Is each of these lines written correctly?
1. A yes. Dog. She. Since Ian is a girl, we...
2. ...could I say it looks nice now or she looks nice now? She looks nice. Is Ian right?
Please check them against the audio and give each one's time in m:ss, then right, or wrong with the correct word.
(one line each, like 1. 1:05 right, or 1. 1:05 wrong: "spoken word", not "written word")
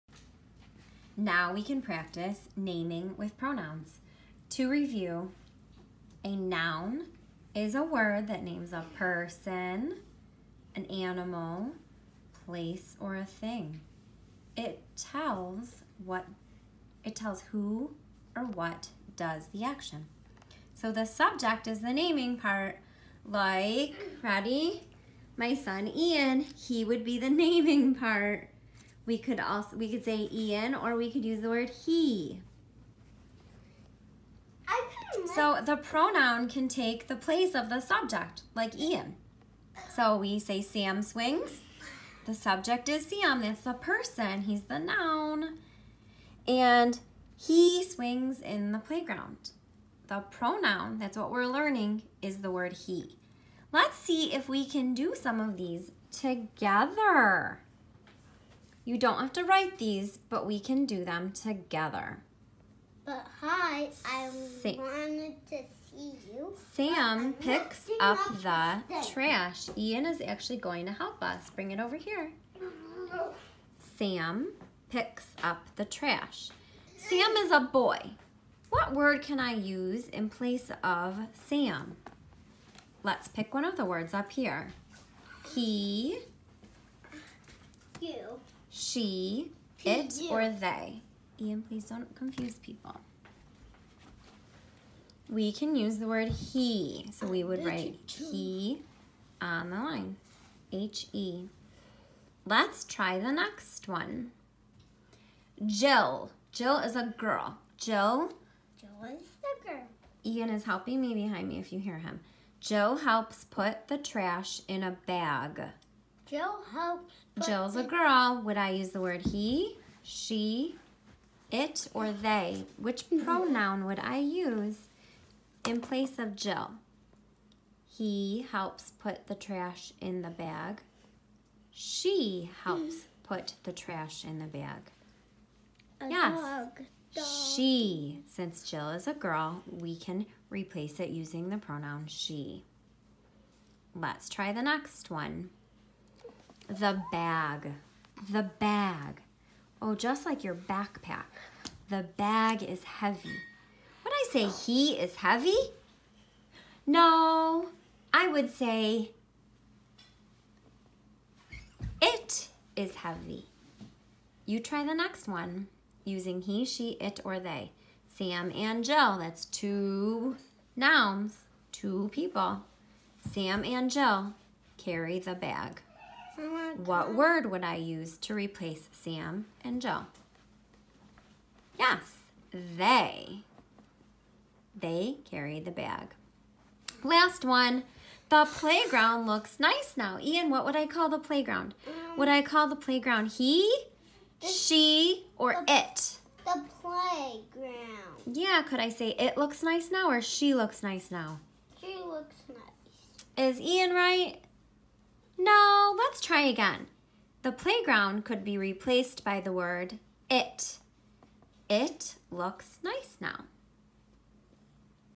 1. 2:15 wrong: "Jill", not "Ian"
2. 3:18 right.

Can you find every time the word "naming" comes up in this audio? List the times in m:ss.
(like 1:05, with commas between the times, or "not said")
0:02, 0:21, 0:27.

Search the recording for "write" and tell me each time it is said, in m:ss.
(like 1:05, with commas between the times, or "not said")
0:59, 1:37.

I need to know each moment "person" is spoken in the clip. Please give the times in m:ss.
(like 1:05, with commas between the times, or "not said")
0:08, 0:43.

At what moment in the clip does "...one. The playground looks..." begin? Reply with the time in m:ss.
3:07.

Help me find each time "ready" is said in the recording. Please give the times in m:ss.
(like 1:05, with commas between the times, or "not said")
0:24.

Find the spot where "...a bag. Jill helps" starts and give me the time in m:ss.
1:54.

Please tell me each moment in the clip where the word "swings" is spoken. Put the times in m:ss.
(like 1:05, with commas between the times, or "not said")
0:41, 0:47.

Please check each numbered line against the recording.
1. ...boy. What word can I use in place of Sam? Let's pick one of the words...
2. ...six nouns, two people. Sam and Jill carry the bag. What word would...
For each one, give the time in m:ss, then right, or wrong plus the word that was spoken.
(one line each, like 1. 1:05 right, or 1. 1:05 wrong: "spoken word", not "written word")
1. 1:17 right
2. 2:49 wrong: "two", not "six".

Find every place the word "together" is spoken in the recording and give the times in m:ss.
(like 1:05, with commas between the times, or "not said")
0:56, 1:01.